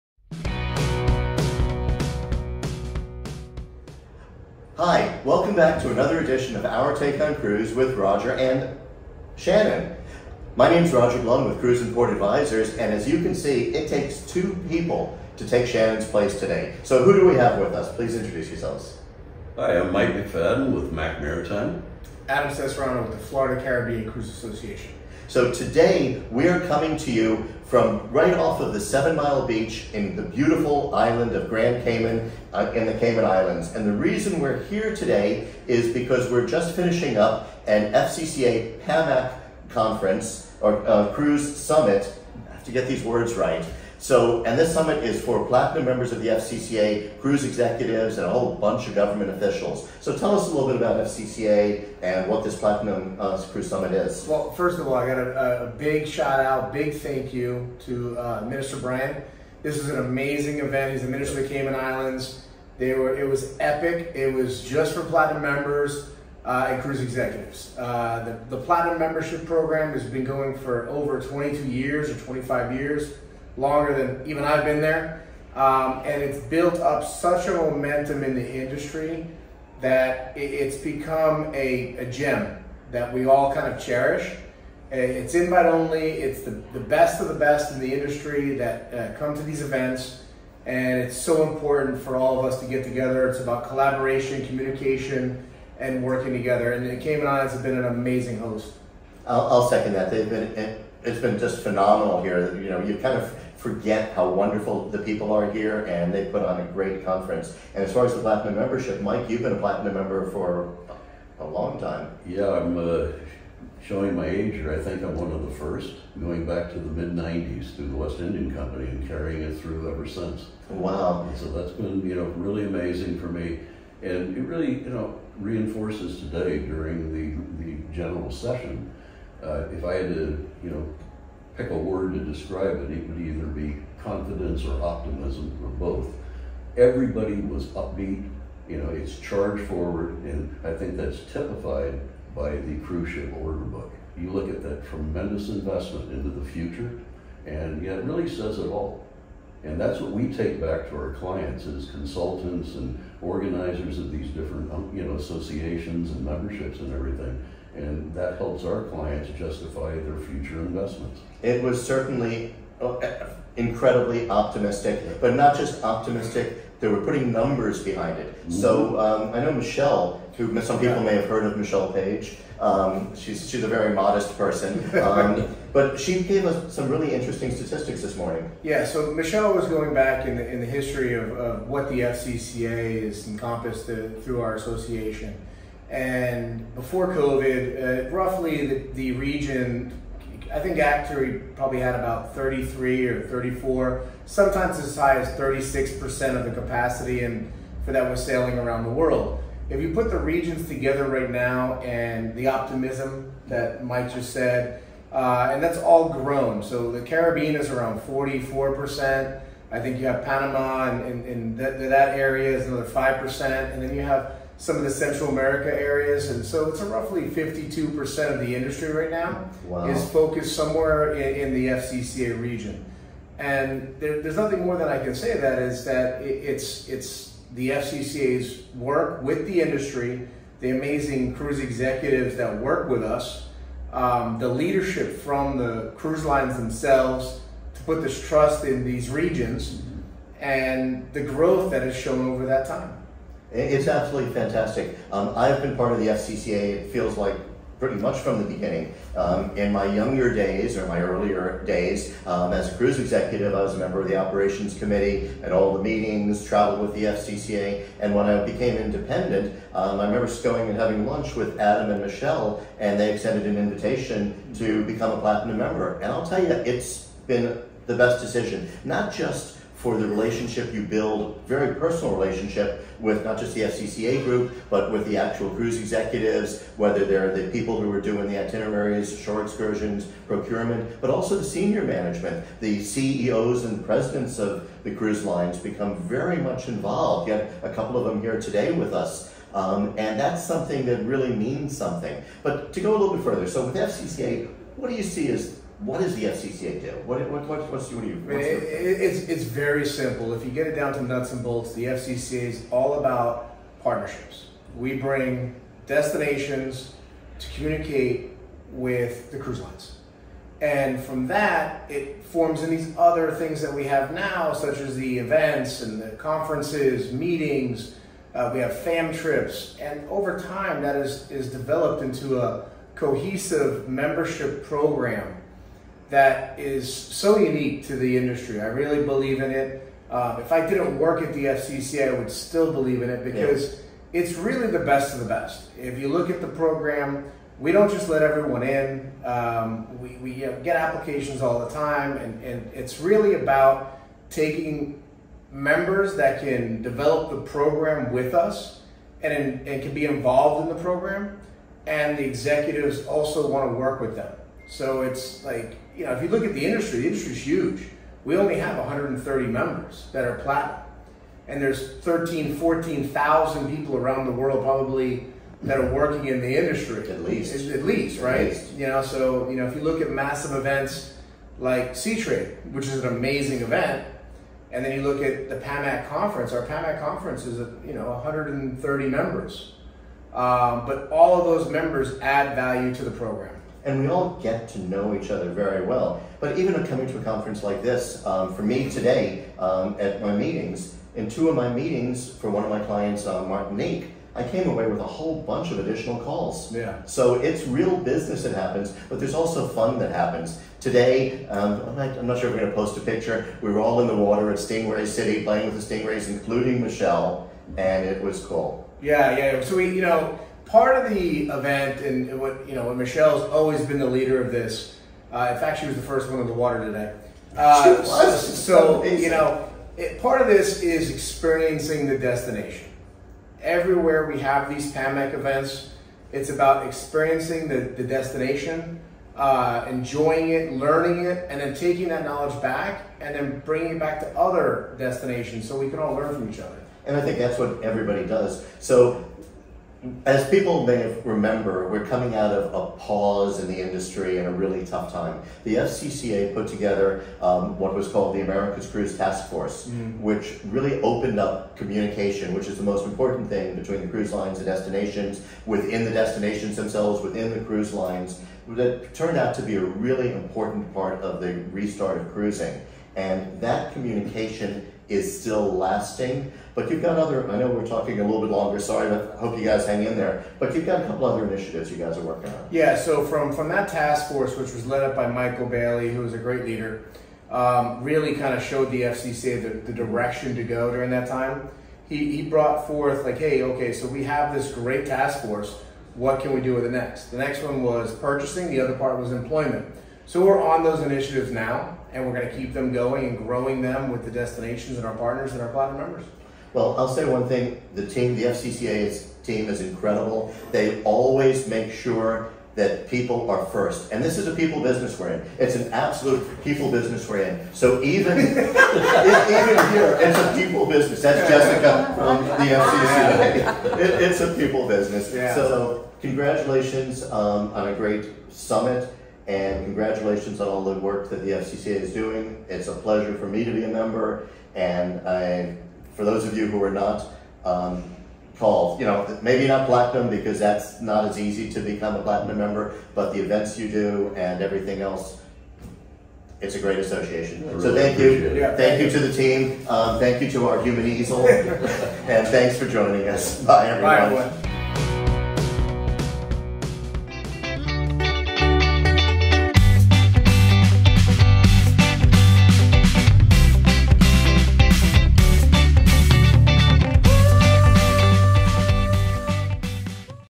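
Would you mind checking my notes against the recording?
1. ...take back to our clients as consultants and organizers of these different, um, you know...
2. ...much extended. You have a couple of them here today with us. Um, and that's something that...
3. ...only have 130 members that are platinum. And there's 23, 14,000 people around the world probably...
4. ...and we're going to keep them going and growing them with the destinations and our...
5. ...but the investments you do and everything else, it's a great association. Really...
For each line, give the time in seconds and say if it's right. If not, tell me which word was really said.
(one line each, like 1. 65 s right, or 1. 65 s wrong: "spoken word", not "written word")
1. 150 s right
2. 286 s wrong: "involved", not "extended"
3. 358 s wrong: "13", not "23"
4. 492 s right
5. 533 s wrong: "events", not "investments".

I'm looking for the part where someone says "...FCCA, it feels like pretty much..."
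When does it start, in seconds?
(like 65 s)
246 s.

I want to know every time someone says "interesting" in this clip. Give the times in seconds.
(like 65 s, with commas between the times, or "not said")
177 s.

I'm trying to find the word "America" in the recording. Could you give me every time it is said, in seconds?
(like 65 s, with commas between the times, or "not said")
215 s, 448 s.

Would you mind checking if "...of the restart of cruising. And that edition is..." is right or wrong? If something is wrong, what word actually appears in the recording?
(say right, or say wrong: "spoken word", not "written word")
wrong: "communication", not "edition".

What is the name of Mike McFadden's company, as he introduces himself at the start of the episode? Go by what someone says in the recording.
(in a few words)
Mac Maritime.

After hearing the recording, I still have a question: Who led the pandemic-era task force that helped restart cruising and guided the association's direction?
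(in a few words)
Michael Bayley.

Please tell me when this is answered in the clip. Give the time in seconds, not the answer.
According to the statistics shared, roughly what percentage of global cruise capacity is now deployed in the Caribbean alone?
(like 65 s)
208 s.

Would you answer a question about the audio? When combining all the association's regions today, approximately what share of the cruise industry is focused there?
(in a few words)
52%.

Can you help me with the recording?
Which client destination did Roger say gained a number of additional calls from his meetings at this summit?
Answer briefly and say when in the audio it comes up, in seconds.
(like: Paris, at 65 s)
Martinique, at 393 s.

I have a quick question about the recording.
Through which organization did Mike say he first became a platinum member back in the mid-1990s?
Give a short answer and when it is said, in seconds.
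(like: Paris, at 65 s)
West Indian Company, at 117 s.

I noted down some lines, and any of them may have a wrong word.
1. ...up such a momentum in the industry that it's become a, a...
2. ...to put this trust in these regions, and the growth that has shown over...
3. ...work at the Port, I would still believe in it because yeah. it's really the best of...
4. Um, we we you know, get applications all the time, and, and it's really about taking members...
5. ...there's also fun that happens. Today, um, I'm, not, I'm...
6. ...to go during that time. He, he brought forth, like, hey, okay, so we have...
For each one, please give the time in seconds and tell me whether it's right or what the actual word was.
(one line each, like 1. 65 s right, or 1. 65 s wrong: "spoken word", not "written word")
1. 76 s right
2. 237 s right
3. 330 s wrong: "FCC", not "Port"
4. 339 s right
5. 399 s right
6. 480 s right.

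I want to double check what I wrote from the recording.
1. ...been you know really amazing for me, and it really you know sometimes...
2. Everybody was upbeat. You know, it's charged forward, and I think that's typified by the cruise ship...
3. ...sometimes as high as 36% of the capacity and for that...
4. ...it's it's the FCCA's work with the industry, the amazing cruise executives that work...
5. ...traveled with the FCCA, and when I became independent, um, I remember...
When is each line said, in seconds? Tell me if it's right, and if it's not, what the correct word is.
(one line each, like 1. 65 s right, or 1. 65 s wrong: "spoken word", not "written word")
1. 121 s wrong: "reinforces", not "sometimes"
2. 136 s right
3. 194 s right
4. 226 s right
5. 256 s right.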